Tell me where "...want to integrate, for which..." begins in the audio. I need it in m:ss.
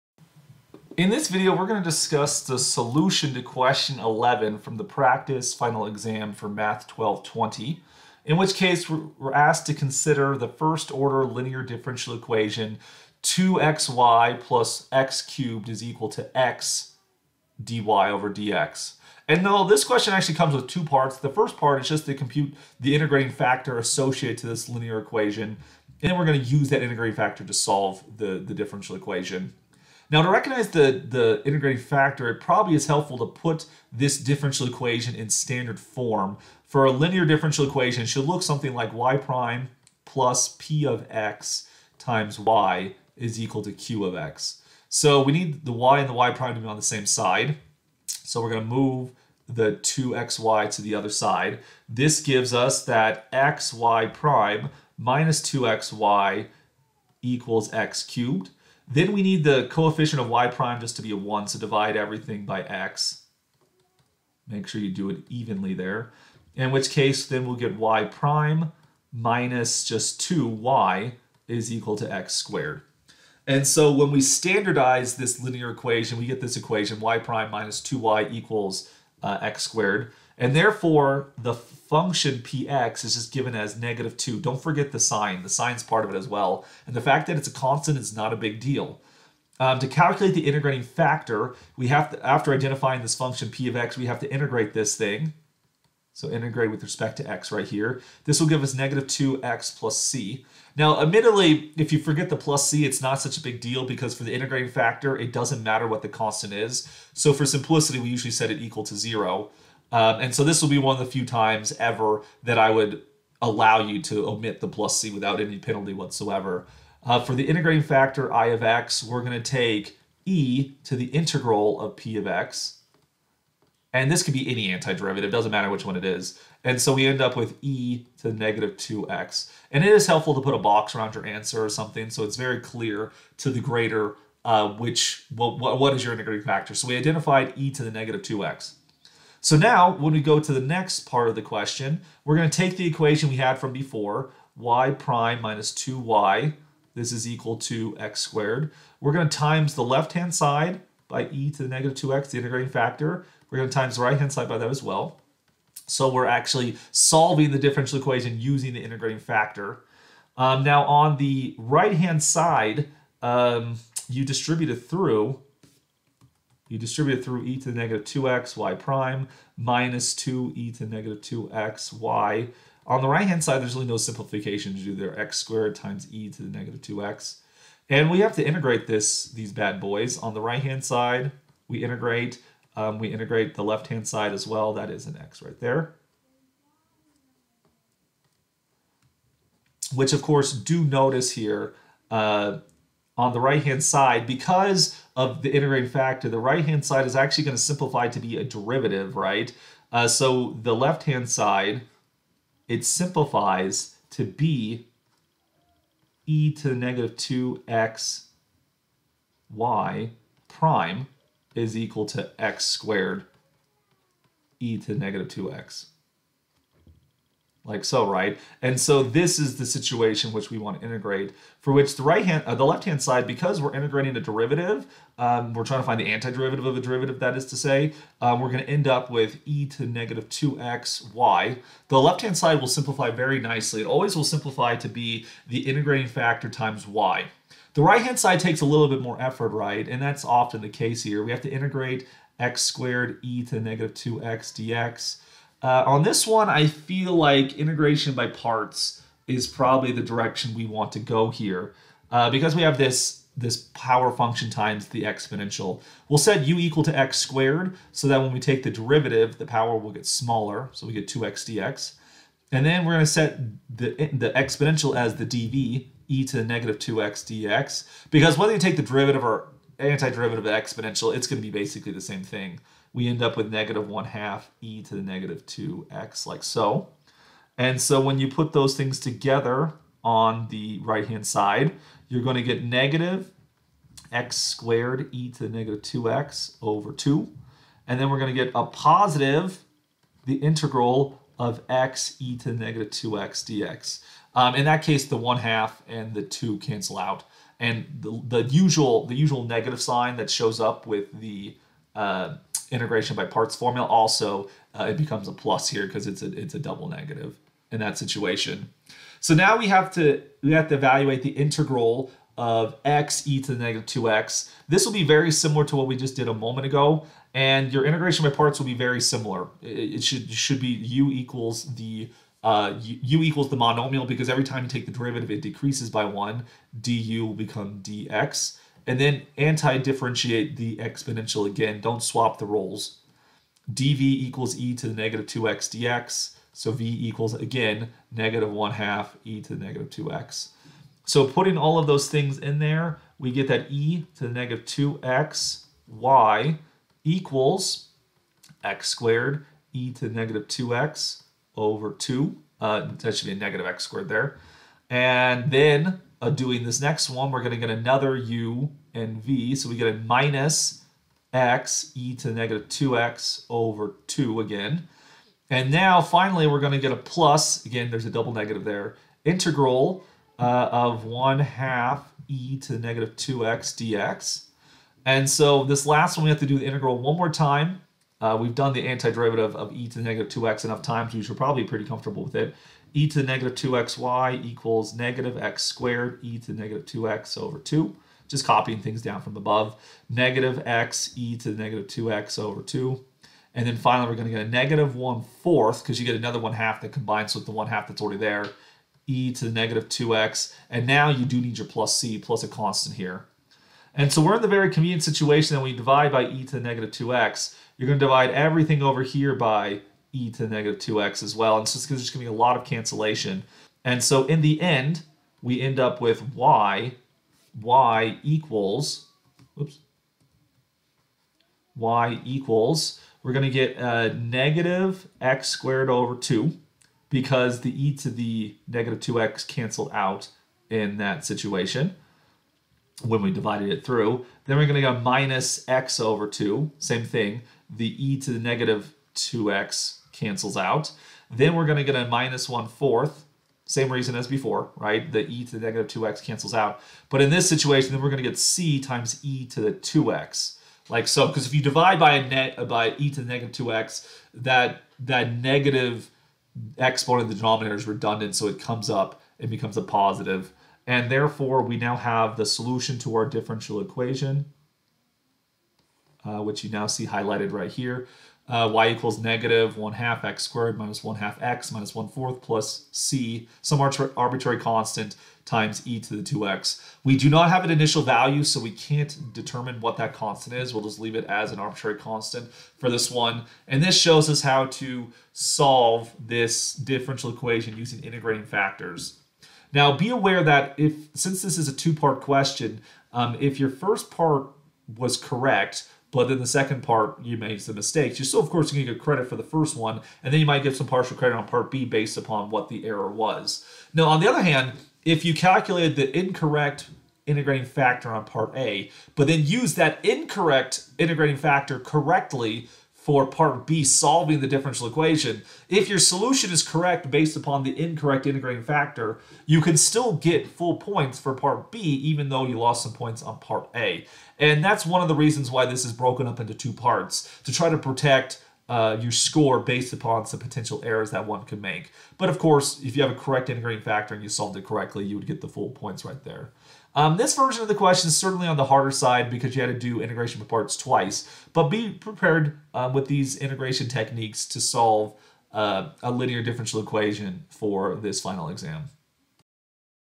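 3:40.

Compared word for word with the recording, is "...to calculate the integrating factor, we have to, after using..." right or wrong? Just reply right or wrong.
wrong.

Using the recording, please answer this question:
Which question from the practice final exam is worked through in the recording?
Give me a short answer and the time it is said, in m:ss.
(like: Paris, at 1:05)
11, at 0:03.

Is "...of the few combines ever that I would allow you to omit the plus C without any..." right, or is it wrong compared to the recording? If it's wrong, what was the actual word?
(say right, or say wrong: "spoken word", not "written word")
wrong: "times", not "combines".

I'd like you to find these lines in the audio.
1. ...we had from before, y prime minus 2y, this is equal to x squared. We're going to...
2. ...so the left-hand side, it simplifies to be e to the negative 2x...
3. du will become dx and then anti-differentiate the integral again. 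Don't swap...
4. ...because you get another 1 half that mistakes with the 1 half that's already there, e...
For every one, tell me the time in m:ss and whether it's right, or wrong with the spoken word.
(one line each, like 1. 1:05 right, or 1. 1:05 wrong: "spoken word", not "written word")
1. 2:23 right
2. 3:20 right
3. 5:26 wrong: "exponential", not "integral"
4. 6:35 wrong: "combines", not "mistakes".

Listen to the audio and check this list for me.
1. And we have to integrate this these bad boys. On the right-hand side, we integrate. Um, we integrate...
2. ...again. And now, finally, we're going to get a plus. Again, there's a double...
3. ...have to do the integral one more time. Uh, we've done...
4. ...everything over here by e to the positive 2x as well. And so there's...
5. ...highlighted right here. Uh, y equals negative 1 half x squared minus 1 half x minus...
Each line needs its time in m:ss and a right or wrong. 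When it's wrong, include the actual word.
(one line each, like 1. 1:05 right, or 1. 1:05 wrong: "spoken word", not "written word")
1. 2:57 right
2. 6:04 right
3. 6:16 right
4. 6:48 wrong: "negative", not "positive"
5. 7:47 right.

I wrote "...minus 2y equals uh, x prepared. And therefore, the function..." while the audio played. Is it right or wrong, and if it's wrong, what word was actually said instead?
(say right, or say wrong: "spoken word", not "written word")
wrong: "squared", not "prepared".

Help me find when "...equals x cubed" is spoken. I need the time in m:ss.
0:57.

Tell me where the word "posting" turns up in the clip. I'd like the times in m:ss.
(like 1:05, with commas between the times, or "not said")
not said.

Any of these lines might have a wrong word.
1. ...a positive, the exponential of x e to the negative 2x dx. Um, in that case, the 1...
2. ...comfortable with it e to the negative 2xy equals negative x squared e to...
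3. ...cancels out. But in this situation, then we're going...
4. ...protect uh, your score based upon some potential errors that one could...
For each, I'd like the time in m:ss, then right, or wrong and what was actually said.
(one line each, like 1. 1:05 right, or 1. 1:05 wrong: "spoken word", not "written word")
1. 4:48 wrong: "integral", not "exponential"
2. 6:21 right
3. 7:26 right
4. 8:47 right.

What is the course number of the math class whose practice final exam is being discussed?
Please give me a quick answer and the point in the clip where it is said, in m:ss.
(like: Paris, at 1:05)
1220, at 0:06.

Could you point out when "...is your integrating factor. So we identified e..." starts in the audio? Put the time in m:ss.
2:15.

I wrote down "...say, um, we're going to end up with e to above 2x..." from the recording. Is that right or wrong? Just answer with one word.
wrong.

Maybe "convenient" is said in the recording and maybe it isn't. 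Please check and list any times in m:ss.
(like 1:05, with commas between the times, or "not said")
6:44.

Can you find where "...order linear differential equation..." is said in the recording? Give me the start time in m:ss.
0:10.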